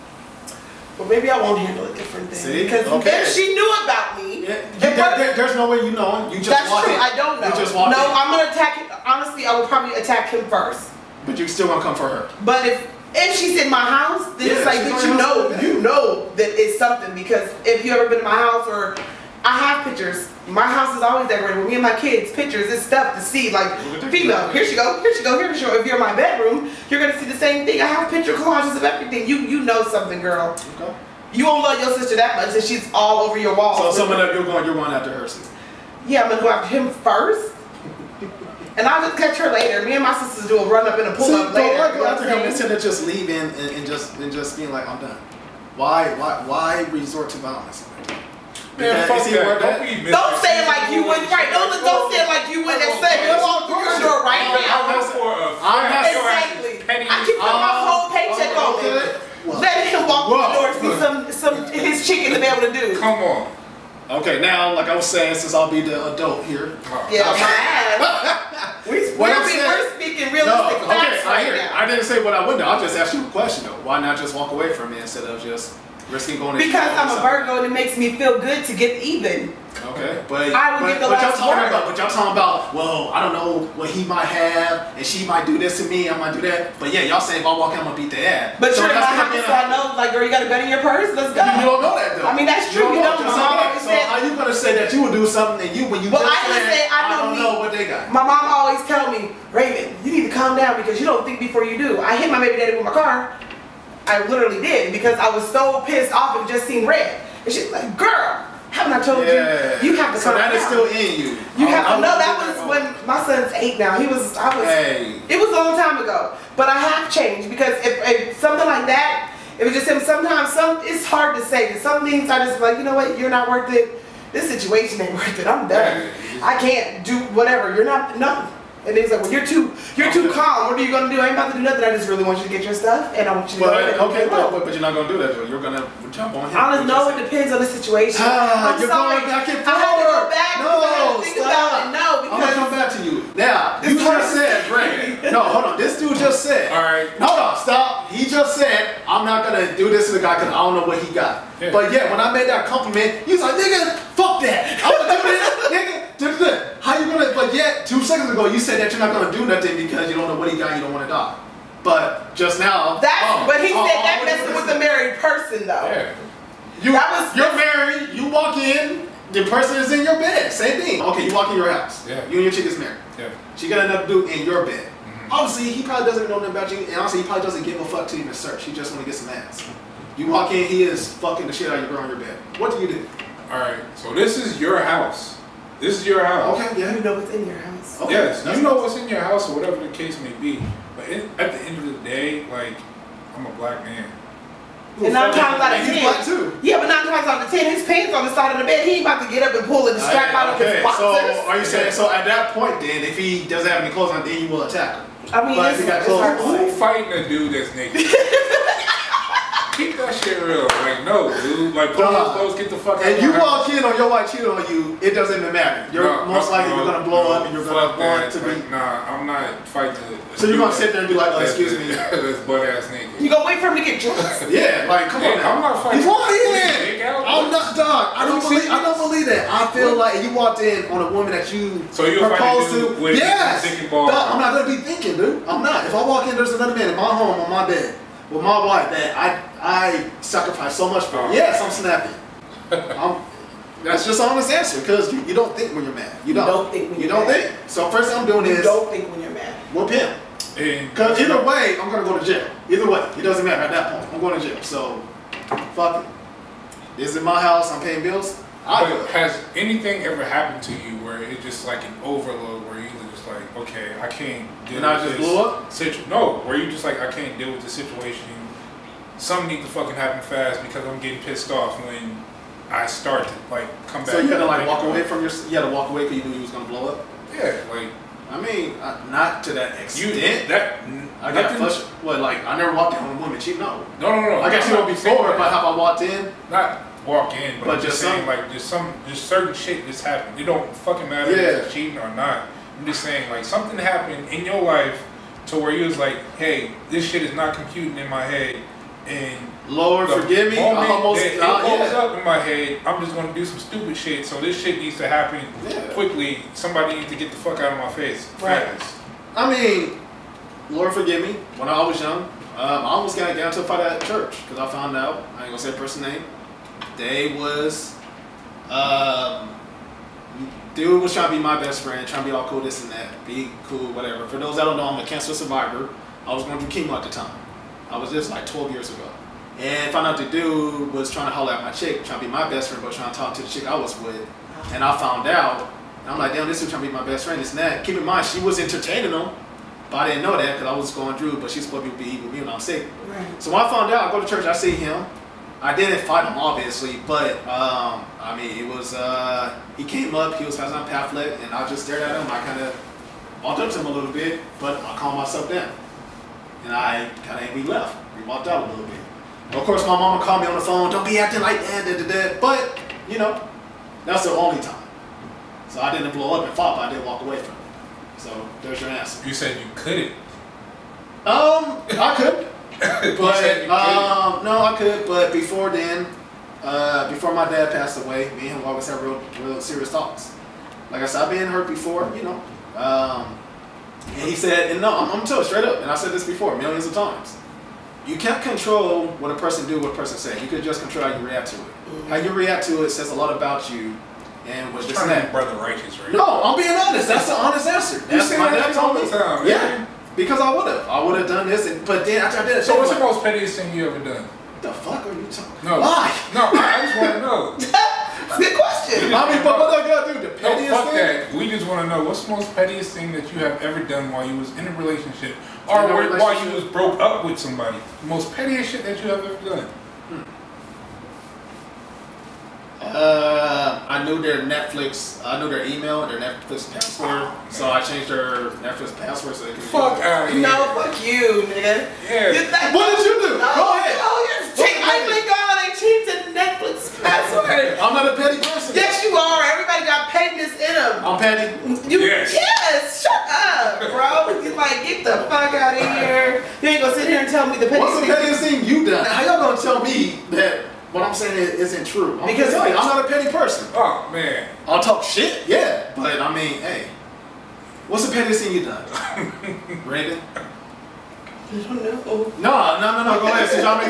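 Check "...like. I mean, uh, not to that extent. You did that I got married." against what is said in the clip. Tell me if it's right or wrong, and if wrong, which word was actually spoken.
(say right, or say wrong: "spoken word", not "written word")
wrong: "flushed", not "married".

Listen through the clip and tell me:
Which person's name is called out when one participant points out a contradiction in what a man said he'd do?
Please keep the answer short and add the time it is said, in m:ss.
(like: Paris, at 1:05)
Brandon, at 2:24.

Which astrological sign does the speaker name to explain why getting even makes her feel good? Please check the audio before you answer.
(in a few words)
Virgo.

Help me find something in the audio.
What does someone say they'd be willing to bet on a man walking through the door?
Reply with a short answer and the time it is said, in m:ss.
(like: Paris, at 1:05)
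Whole paycheck, at 0:57.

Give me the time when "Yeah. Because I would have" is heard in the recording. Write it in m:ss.
6:39.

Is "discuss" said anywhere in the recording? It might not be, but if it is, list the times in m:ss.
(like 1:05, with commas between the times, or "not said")
not said.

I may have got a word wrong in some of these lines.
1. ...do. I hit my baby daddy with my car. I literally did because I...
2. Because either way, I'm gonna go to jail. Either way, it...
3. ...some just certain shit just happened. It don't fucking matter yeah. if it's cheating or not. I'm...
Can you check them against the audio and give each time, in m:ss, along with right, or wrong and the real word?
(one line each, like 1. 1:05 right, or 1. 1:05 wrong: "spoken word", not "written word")
1. 1:41 right
2. 4:10 right
3. 4:48 right.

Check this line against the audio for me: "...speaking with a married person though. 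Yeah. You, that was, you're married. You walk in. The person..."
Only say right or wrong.
wrong.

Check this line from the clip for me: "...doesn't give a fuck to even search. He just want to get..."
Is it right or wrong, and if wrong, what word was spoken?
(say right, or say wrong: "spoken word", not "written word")
right.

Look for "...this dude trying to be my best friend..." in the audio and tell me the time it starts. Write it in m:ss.
5:36.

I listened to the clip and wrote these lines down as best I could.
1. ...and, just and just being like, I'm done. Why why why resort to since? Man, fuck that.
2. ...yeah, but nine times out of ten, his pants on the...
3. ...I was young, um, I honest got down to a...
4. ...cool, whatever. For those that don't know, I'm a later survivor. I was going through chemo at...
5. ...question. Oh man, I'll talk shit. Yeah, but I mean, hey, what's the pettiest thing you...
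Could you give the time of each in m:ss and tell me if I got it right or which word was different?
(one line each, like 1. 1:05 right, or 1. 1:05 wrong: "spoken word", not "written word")
1. 0:43 wrong: "violence", not "since"
2. 3:16 right
3. 5:11 wrong: "almost", not "honest"
4. 5:23 wrong: "cancer", not "later"
5. 7:33 wrong: "person", not "question".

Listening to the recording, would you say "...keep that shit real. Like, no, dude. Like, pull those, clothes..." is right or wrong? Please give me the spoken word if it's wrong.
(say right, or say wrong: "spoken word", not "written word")
right.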